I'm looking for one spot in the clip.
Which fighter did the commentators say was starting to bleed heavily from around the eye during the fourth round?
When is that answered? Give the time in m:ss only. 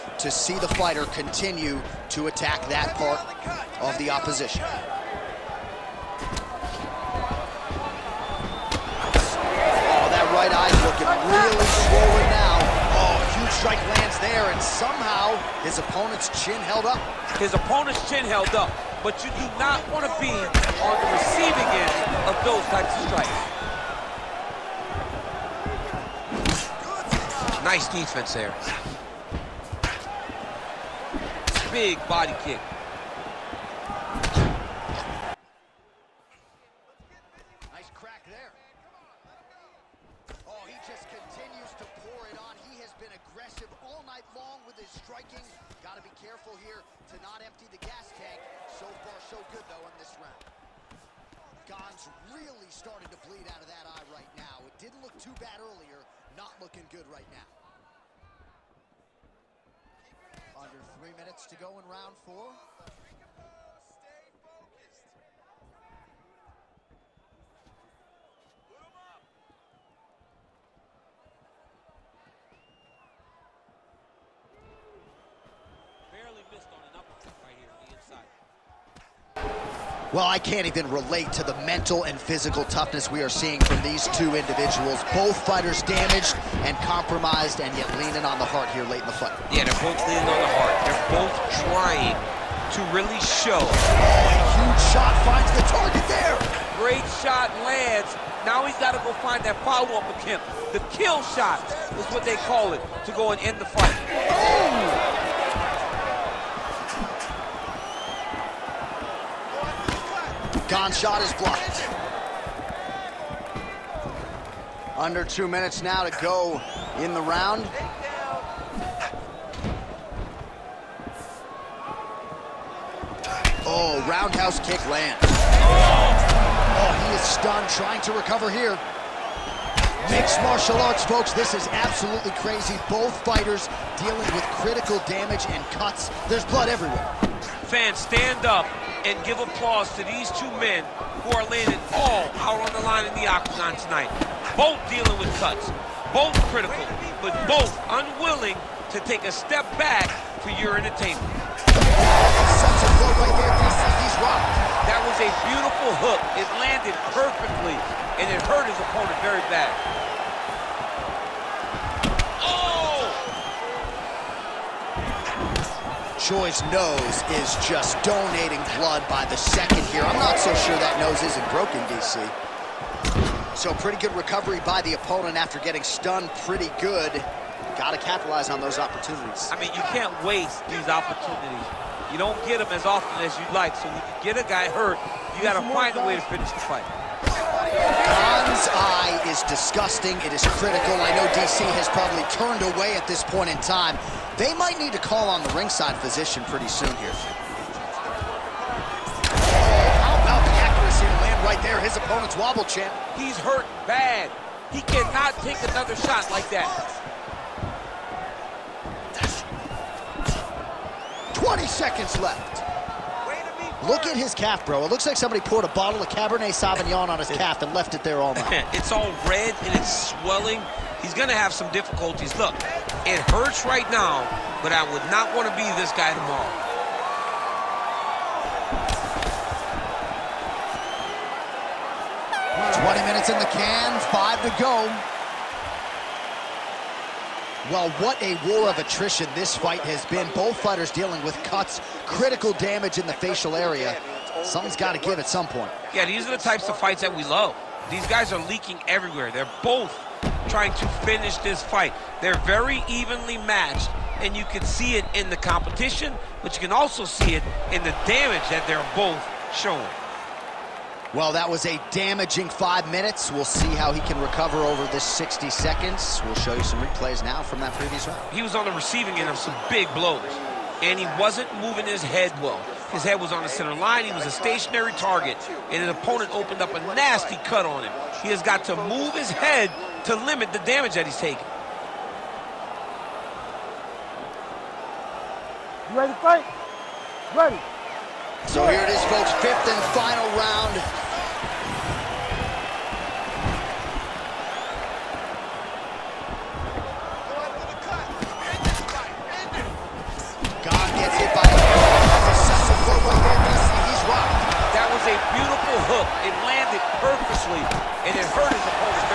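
0:51.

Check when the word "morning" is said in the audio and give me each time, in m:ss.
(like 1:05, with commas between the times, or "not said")
not said.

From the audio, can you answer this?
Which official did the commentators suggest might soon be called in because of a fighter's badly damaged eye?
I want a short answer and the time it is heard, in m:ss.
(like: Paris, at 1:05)
Ringside physician, at 3:15.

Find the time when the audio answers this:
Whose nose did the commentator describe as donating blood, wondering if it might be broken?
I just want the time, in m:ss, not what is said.
2:46.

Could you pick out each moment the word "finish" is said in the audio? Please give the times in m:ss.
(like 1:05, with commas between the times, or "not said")
3:06, 4:11.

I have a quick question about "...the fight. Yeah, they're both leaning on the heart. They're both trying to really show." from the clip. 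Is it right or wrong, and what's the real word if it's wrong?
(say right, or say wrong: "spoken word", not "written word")
right.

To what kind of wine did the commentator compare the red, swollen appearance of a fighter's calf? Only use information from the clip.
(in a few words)
Cabernet Sauvignon.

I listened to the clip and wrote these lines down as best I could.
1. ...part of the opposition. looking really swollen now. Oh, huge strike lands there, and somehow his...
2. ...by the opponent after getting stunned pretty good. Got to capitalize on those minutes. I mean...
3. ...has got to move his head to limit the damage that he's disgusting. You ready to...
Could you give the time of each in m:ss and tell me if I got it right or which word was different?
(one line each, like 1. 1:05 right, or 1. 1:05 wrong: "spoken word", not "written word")
1. 0:02 right
2. 2:54 wrong: "opportunities", not "minutes"
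3. 4:38 wrong: "taking", not "disgusting".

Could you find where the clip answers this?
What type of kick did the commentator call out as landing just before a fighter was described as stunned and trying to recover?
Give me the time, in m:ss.
2:04.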